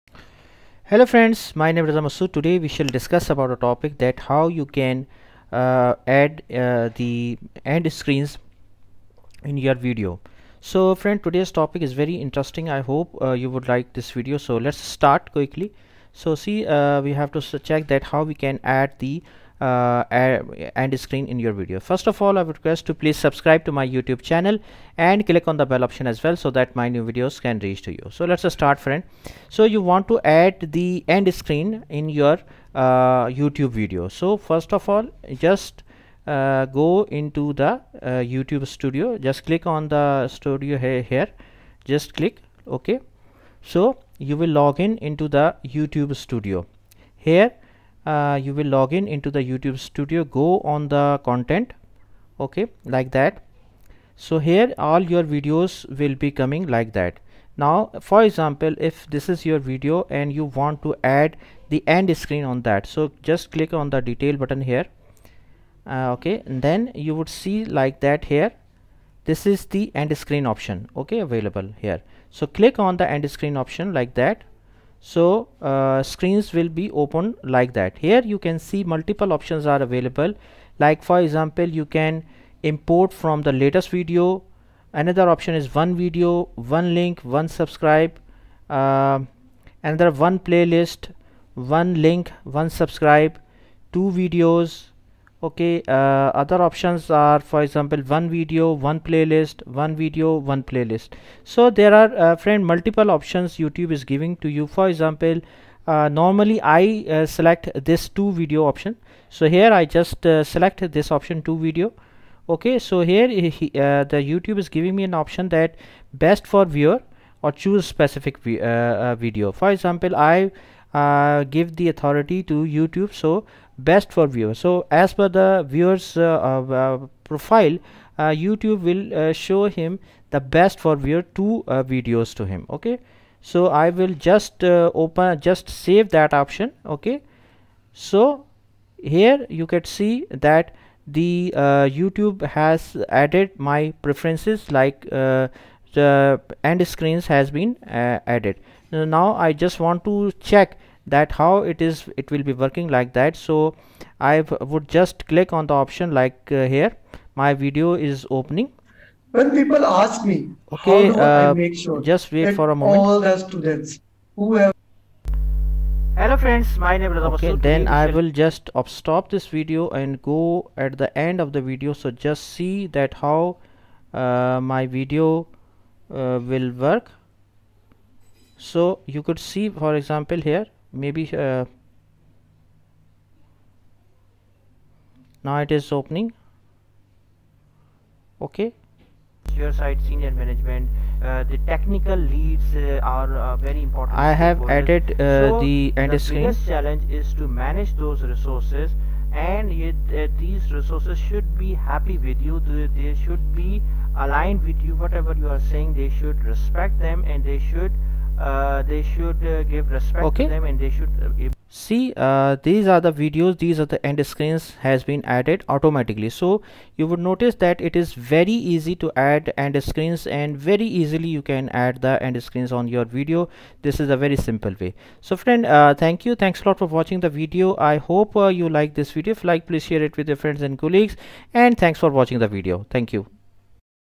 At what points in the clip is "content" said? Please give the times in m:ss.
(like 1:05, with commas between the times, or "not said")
0:51.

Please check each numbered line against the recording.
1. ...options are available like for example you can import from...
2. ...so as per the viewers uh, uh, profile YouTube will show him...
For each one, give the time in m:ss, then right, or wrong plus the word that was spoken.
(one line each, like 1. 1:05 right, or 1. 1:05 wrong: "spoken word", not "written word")
1. 1:19 right
2. 2:04 right.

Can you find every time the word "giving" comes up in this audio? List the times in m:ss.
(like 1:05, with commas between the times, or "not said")
1:44, 1:54.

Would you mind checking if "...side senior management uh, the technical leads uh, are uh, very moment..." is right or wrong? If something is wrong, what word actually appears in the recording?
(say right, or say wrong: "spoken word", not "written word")
wrong: "important", not "moment".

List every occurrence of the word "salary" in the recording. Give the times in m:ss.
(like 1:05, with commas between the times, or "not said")
not said.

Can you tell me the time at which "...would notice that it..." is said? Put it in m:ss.
3:37.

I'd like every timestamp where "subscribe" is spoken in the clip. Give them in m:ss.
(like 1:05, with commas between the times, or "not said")
0:23, 1:27, 1:32.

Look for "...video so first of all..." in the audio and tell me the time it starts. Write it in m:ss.
0:33.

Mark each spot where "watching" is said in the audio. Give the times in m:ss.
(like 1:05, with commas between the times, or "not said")
3:46, 3:52.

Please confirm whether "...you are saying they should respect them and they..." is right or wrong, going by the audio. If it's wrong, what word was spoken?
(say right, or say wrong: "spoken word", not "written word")
right.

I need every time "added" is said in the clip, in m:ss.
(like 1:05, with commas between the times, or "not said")
2:23, 2:28, 3:14, 3:35.